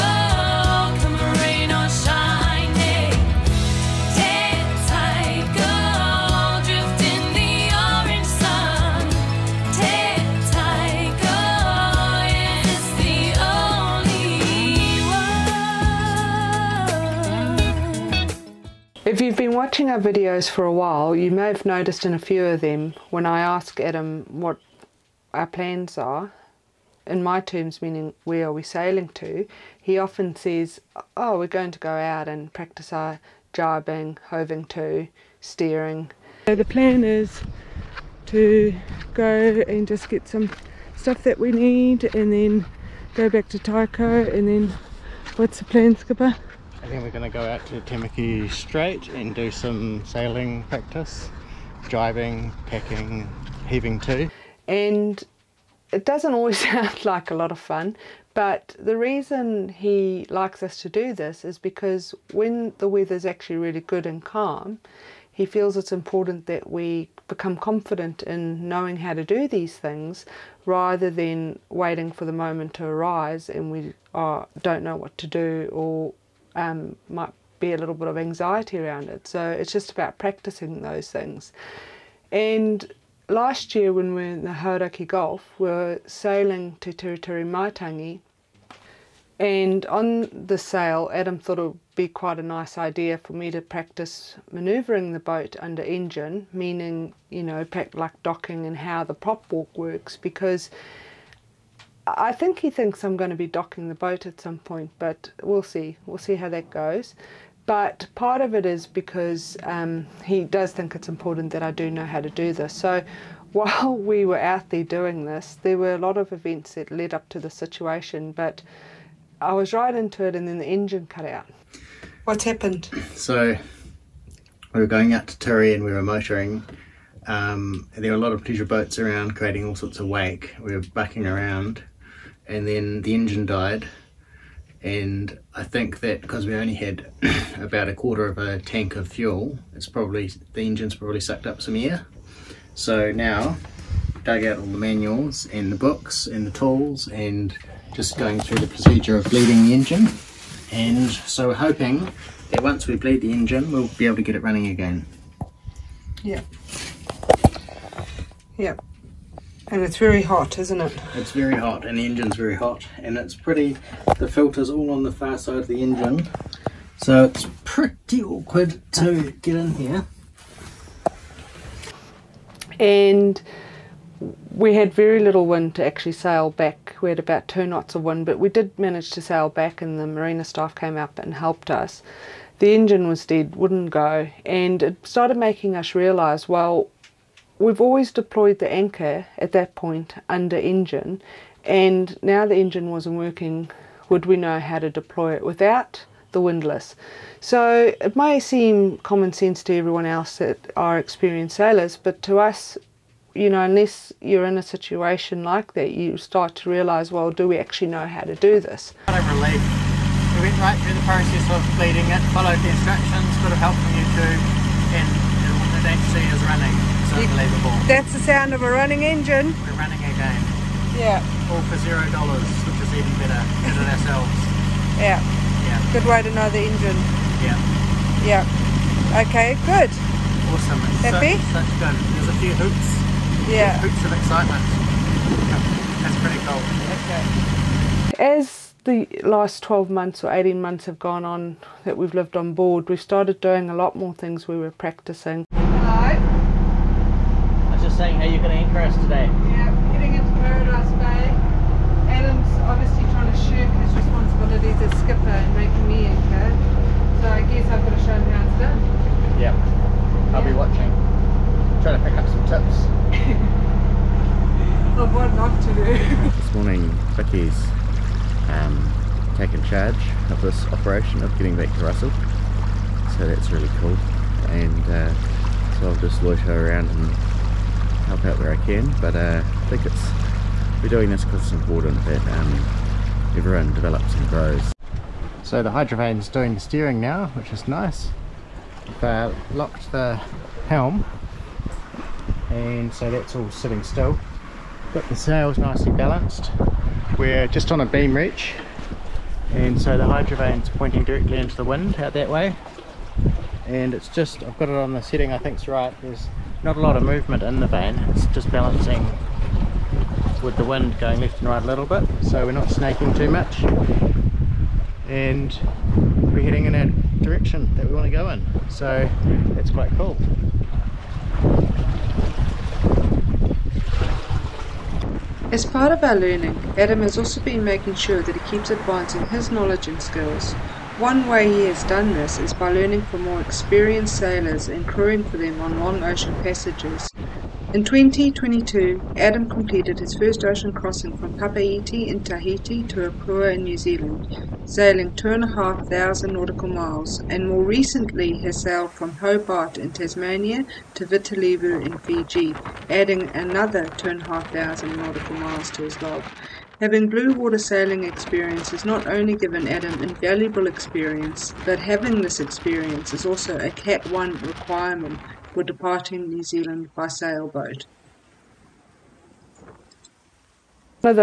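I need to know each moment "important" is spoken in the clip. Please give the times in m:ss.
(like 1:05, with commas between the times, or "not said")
1:05, 1:51, 4:41.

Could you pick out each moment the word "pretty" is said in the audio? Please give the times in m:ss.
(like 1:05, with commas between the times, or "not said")
2:43, 2:47, 3:56.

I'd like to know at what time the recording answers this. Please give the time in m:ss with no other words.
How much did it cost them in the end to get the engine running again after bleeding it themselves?
3:41.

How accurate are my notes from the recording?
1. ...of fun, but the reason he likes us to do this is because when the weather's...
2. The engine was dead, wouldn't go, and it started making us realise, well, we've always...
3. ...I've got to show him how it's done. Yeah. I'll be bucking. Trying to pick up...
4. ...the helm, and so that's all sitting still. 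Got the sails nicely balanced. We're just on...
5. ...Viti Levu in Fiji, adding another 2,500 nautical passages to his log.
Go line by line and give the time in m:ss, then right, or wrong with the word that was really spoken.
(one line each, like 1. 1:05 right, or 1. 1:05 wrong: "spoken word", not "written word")
1. 0:57 right
2. 3:02 right
3. 4:17 wrong: "watching", not "bucking"
4. 4:49 right
5. 5:51 wrong: "miles", not "passages".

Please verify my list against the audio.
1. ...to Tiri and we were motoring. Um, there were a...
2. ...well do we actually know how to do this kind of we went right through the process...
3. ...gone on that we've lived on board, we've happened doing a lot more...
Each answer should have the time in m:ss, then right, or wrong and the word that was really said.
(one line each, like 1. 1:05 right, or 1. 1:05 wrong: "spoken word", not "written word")
1. 2:05 right
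2. 3:27 right
3. 4:00 wrong: "started", not "happened".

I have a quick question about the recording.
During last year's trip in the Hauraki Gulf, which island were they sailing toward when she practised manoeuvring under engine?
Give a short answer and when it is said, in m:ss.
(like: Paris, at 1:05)
Tiritiri Matangi, at 1:26.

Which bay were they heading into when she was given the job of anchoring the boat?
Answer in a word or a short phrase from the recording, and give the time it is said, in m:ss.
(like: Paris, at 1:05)
Paradise Bay, at 4:10.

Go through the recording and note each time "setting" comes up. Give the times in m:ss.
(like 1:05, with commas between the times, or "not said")
5:05.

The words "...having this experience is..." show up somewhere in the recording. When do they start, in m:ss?
6:01.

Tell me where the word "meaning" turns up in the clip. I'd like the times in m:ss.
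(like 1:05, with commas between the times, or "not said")
0:27, 1:36.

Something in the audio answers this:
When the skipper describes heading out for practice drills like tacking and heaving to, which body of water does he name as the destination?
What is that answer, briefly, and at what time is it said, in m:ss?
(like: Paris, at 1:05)
Tamaki Strait, at 0:47.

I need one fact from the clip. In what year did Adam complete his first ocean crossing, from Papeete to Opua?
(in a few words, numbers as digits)
2022.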